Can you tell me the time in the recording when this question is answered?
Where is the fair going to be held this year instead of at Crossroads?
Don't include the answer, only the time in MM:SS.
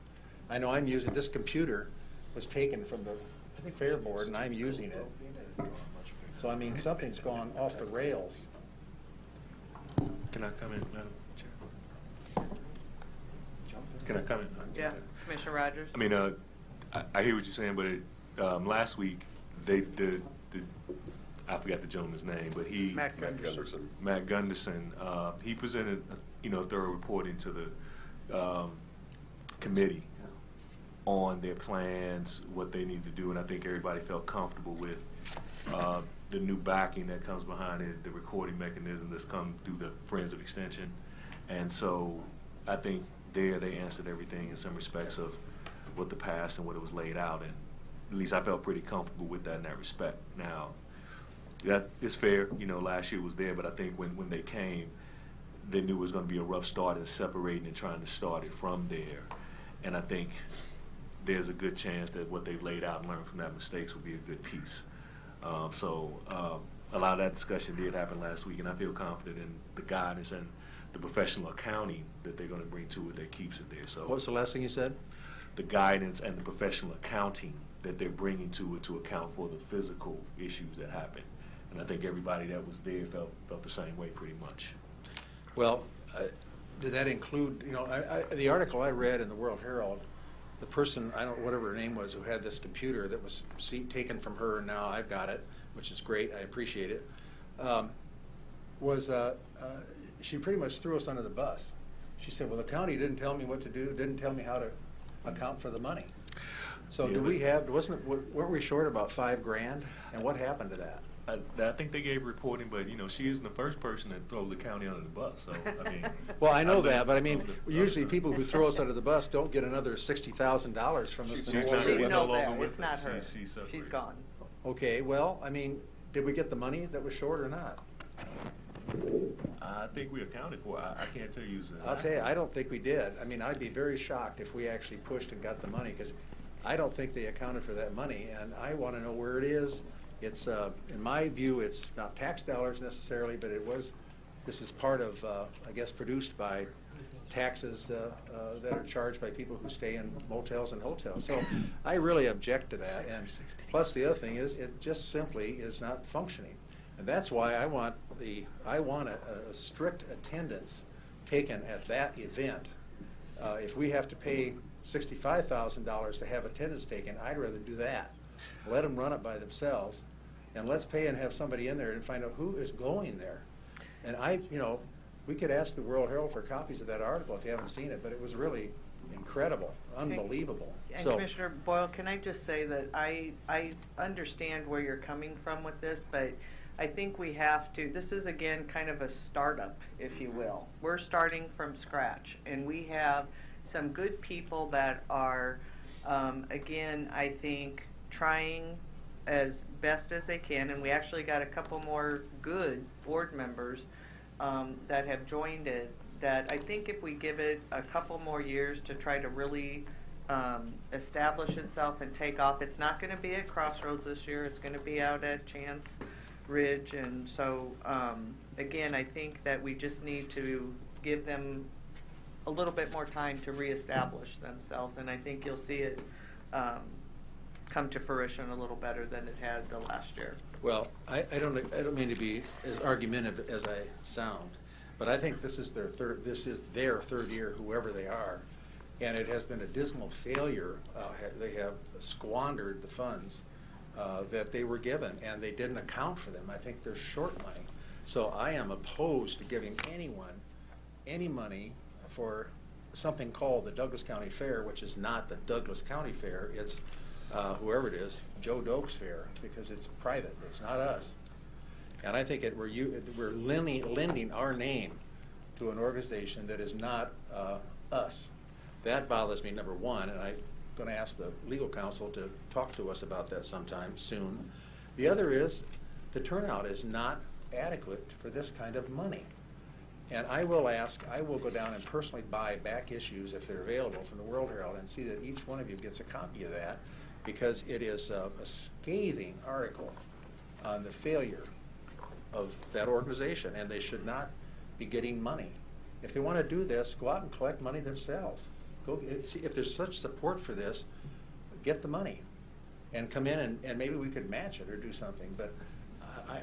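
03:35.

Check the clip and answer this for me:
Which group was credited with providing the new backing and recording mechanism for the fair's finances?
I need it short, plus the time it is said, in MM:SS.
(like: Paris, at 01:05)
Friends of Extension, at 00:40.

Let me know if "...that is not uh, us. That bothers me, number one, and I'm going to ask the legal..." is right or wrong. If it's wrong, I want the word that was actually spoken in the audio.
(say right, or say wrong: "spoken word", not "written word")
right.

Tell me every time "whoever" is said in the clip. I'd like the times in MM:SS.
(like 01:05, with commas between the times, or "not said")
03:57, 04:17.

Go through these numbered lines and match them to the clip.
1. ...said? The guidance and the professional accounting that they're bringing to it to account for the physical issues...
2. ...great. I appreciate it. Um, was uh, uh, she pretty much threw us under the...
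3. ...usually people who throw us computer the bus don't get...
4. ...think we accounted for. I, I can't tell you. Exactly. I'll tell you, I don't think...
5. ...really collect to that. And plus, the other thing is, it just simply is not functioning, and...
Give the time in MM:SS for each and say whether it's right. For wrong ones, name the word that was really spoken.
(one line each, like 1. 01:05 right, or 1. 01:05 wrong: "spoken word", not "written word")
1. 01:14 right
2. 01:36 right
3. 01:57 wrong: "under", not "computer"
4. 02:09 right
5. 02:31 wrong: "object", not "collect".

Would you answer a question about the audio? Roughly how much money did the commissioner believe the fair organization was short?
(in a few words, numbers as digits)
5 grand.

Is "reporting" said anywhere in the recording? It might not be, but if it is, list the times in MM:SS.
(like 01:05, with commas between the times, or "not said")
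00:26, 01:52.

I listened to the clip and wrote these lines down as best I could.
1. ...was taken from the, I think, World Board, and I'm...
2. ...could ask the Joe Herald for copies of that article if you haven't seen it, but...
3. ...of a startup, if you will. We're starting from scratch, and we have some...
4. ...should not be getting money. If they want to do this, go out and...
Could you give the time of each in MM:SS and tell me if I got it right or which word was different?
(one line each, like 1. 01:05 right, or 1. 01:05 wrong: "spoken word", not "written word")
1. 00:02 wrong: "Fair", not "World"
2. 02:55 wrong: "World", not "Joe"
3. 03:08 right
4. 04:53 right.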